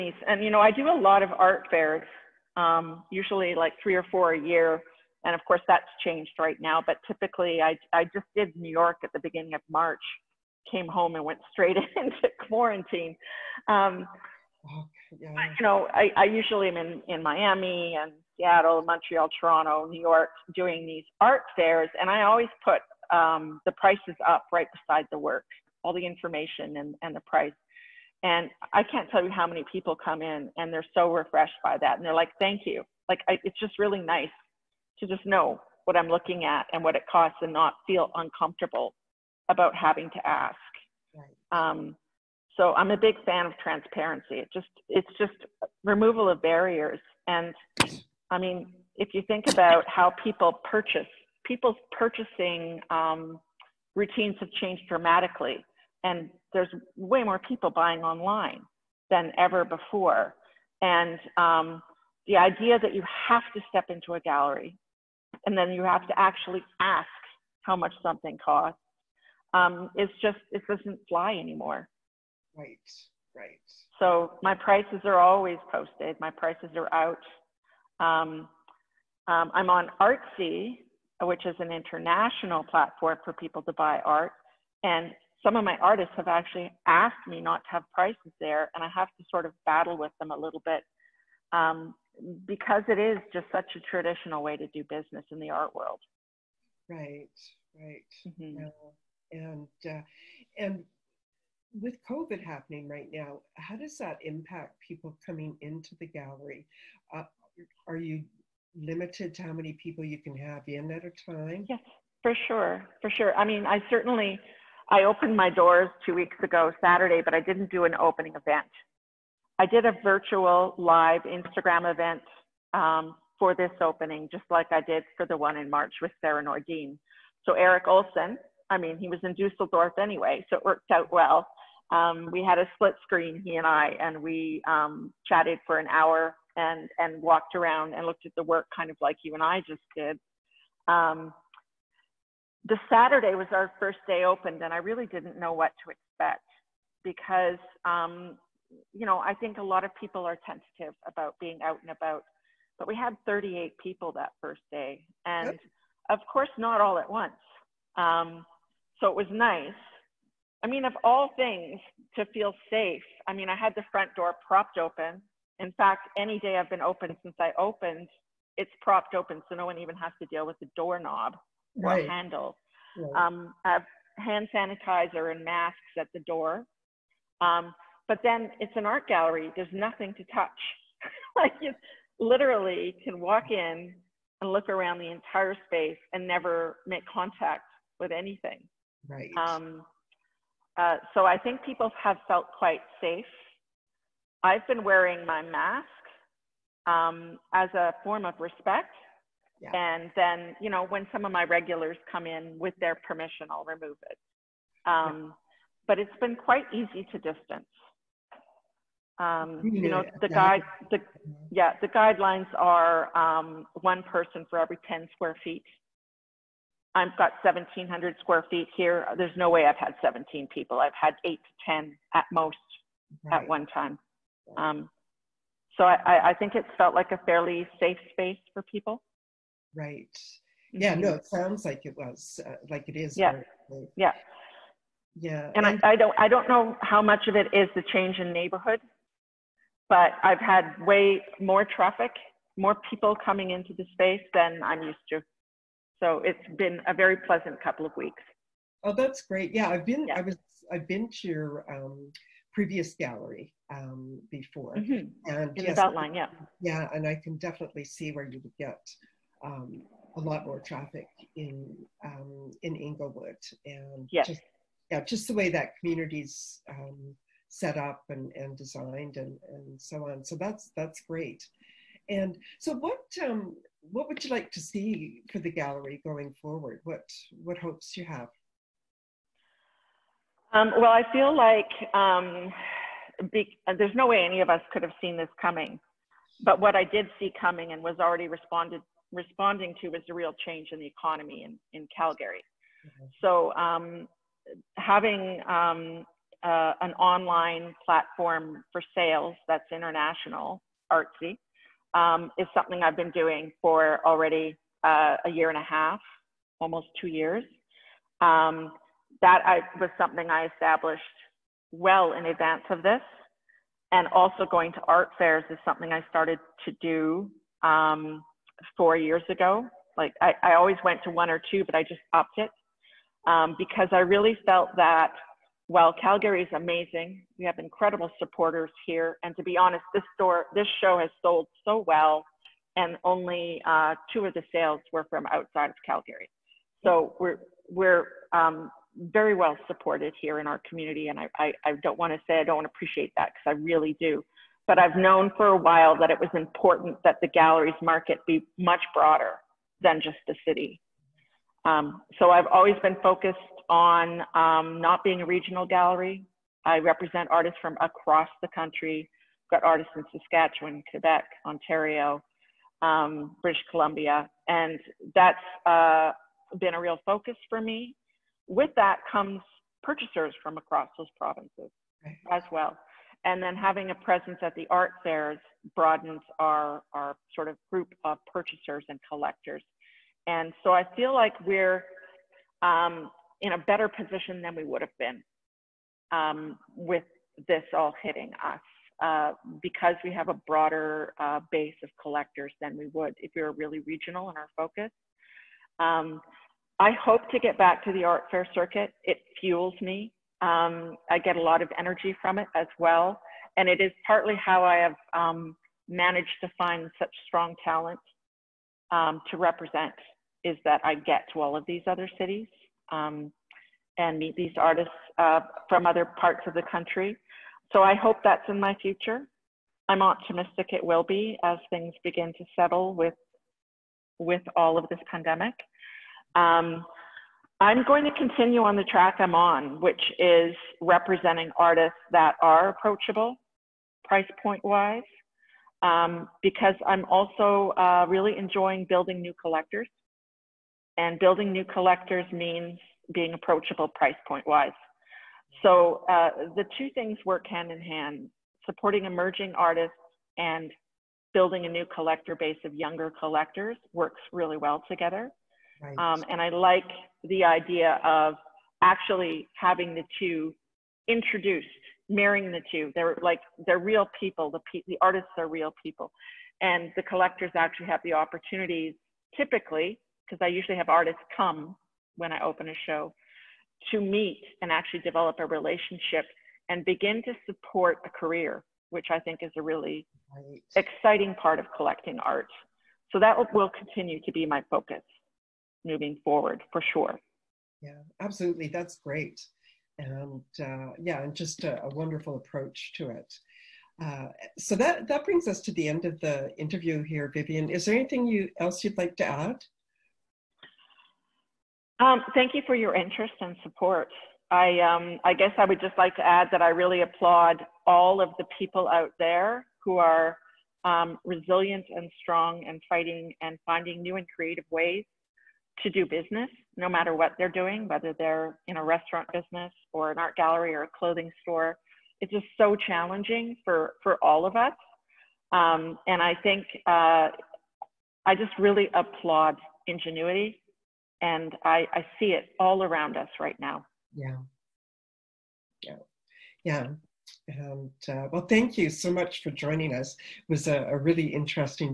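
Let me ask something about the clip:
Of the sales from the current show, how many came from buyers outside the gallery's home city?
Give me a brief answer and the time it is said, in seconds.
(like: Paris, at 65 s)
2, at 334 s.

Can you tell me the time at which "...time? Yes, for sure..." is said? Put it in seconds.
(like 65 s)
111 s.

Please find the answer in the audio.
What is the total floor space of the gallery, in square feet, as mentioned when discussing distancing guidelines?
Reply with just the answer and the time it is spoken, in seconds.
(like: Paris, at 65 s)
1,700 square feet, at 217 s.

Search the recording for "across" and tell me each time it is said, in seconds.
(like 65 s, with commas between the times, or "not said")
357 s, 370 s.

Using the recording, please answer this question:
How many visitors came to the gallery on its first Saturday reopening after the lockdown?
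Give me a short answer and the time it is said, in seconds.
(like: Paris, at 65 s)
38, at 152 s.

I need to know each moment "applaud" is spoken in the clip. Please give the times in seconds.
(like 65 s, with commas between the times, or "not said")
507 s, 528 s.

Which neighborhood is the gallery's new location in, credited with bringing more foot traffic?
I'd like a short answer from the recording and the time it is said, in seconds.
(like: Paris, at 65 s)
Inglewood, at 262 s.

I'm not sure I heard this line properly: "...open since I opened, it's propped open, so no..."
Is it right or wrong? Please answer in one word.
right.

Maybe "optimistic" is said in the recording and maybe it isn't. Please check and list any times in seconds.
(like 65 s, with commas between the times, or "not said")
420 s.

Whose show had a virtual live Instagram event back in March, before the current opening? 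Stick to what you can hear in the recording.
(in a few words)
Sarah Nordean.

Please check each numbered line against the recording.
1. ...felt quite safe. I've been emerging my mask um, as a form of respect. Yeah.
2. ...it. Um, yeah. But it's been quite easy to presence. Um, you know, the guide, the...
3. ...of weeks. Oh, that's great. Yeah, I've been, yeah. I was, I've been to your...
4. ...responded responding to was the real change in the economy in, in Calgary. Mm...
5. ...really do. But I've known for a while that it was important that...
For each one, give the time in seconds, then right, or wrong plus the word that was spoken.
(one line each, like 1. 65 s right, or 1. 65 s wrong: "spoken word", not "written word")
1. 192 s wrong: "wearing", not "emerging"
2. 204 s wrong: "distance", not "presence"
3. 247 s right
4. 288 s right
5. 343 s right.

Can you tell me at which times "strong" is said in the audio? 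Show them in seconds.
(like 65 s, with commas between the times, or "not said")
407 s, 512 s.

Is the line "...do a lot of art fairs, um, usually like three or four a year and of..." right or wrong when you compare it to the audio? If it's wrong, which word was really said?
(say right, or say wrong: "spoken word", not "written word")
right.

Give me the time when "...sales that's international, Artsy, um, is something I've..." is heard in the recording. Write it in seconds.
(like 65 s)
298 s.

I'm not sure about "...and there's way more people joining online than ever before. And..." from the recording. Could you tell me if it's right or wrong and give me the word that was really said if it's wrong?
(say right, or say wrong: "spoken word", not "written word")
wrong: "buying", not "joining".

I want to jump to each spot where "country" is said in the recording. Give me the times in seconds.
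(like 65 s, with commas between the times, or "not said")
358 s, 416 s.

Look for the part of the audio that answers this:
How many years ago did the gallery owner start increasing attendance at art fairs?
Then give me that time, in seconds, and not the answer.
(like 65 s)
318 s.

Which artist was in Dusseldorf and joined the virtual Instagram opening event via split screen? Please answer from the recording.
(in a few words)
Erik Olson.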